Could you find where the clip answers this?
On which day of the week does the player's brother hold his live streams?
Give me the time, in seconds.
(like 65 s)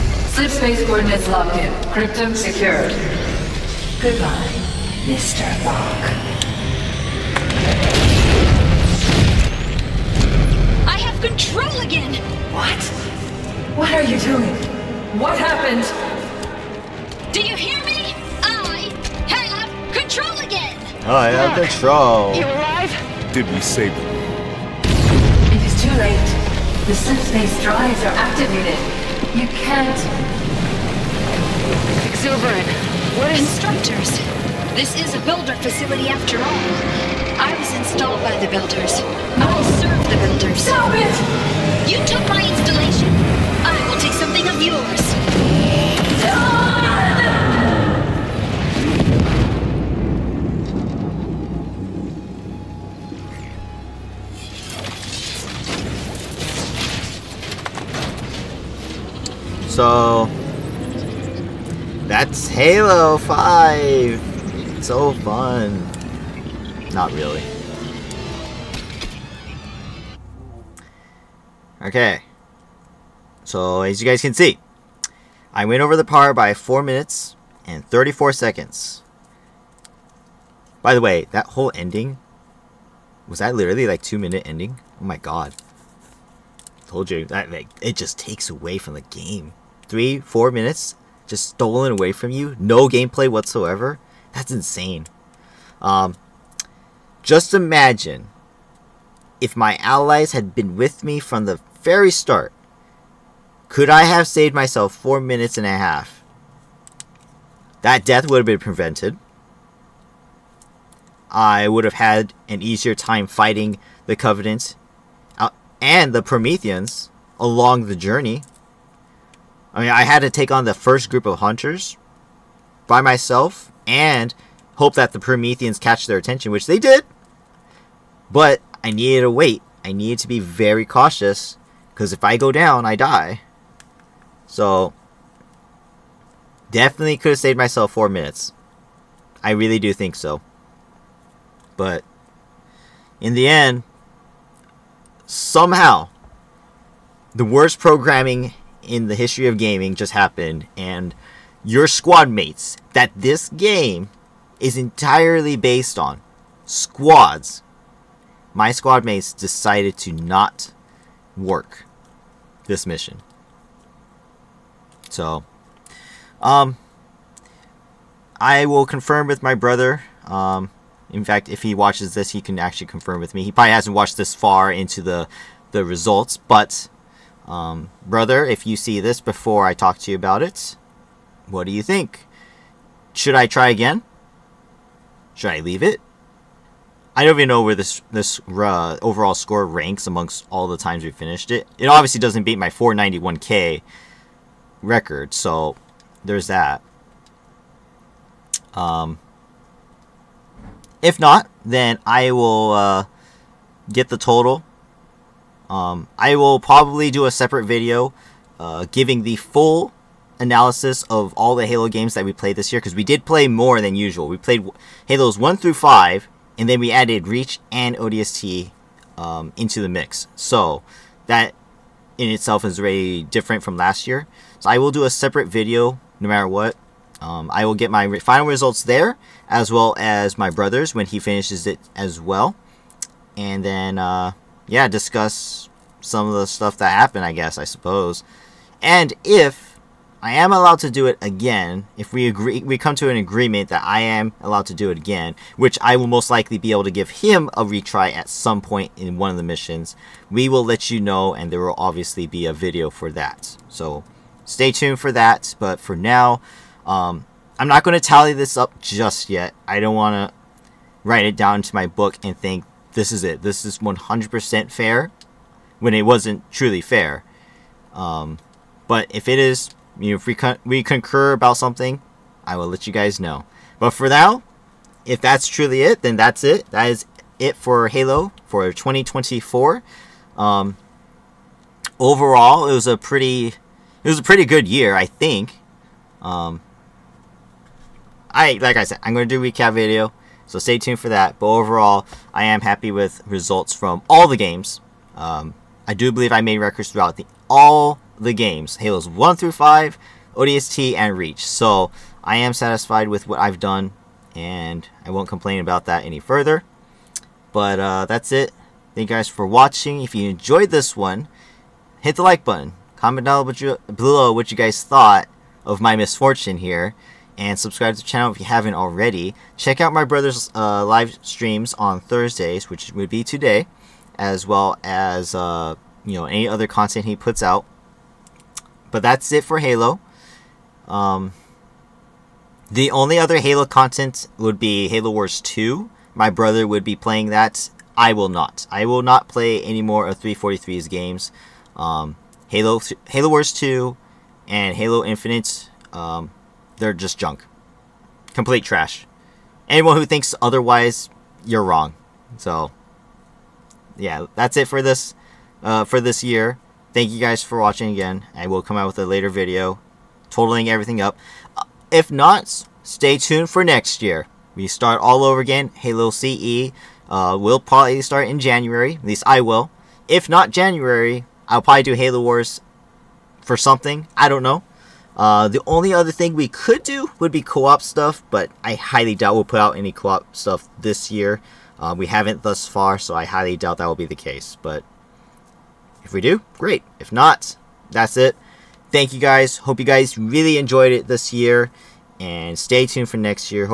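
322 s.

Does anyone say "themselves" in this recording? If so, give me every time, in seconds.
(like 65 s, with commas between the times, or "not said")
not said.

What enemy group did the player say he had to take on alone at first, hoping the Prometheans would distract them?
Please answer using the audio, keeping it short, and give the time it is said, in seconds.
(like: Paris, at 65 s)
hunters, at 121 s.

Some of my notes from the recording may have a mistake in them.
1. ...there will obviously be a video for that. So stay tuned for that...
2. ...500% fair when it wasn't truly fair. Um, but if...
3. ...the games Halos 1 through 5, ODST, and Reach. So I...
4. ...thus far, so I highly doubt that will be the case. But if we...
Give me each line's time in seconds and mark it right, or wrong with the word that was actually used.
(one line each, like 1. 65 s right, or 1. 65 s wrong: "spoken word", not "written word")
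1. 251 s right
2. 263 s wrong: "100", not "500"
3. 298 s right
4. 382 s right.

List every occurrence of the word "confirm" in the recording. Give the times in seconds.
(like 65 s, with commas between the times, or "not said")
168 s, 172 s.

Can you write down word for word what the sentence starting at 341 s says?
Um, Halo, Halo Wars 2 and Halo Infinite, um, they're just junk.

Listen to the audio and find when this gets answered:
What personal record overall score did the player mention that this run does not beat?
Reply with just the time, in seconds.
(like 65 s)
192 s.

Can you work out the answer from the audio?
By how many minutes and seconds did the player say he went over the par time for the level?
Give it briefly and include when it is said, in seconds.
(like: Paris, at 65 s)
4 minutes 34 seconds, at 76 s.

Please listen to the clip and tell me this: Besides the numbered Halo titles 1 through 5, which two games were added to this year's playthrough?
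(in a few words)
Reach and ODST.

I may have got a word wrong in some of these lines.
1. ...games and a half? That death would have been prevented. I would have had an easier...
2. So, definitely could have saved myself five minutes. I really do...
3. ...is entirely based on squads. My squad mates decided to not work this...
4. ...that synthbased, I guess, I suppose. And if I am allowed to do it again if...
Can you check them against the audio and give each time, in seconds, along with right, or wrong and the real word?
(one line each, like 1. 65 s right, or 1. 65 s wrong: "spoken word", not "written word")
1. 105 s wrong: "minutes", not "games"
2. 134 s wrong: "four", not "five"
3. 154 s right
4. 236 s wrong: "happened", not "synthbased".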